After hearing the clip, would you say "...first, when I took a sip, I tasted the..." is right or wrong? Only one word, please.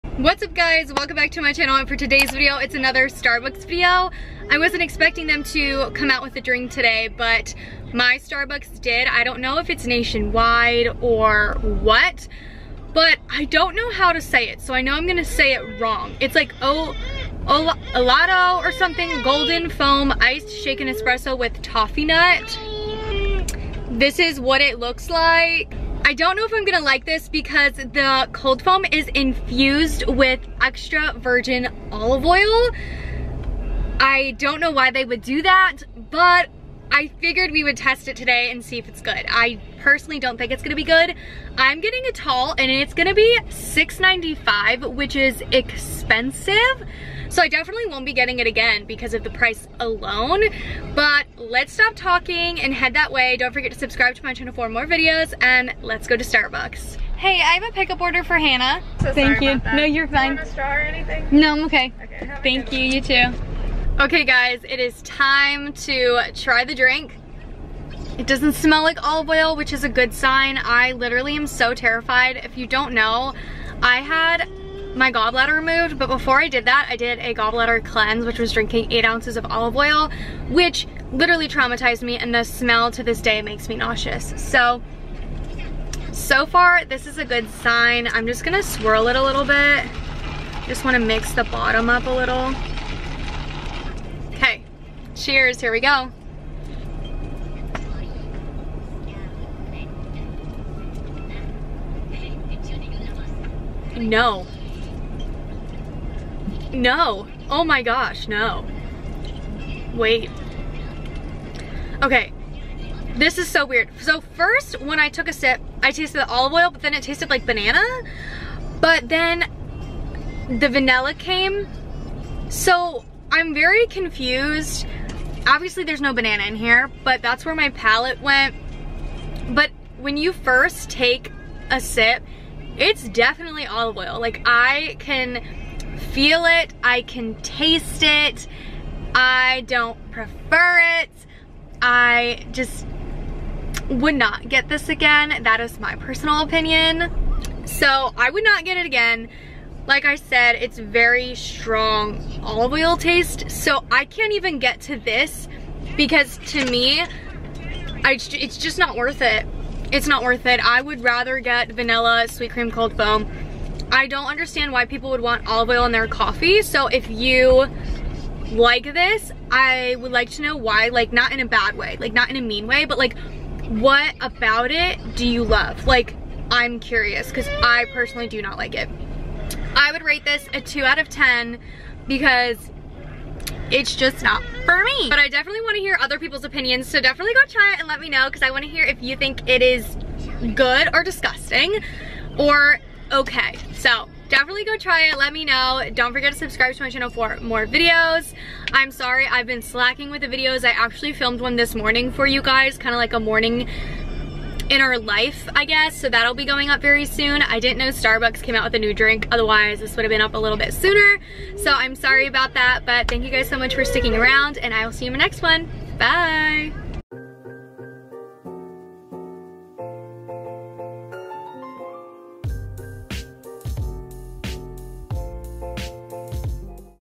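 right.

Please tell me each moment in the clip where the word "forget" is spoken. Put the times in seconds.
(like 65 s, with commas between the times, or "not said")
53 s, 196 s.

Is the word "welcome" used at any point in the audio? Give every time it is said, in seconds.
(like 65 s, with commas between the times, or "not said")
0 s.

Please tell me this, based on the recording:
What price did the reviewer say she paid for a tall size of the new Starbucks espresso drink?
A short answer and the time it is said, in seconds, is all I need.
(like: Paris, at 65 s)
$6.95, at 43 s.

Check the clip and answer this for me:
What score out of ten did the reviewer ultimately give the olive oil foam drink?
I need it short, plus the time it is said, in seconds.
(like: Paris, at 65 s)
2, at 180 s.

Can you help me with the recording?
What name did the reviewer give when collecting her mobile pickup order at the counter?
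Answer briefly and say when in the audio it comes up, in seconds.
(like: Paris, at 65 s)
Hannah, at 58 s.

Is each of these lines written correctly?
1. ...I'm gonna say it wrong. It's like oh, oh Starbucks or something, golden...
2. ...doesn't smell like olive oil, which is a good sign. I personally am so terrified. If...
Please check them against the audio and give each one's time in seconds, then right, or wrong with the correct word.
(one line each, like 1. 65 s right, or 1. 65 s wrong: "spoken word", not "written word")
1. 14 s wrong: "Elato", not "Starbucks"
2. 68 s wrong: "literally", not "personally".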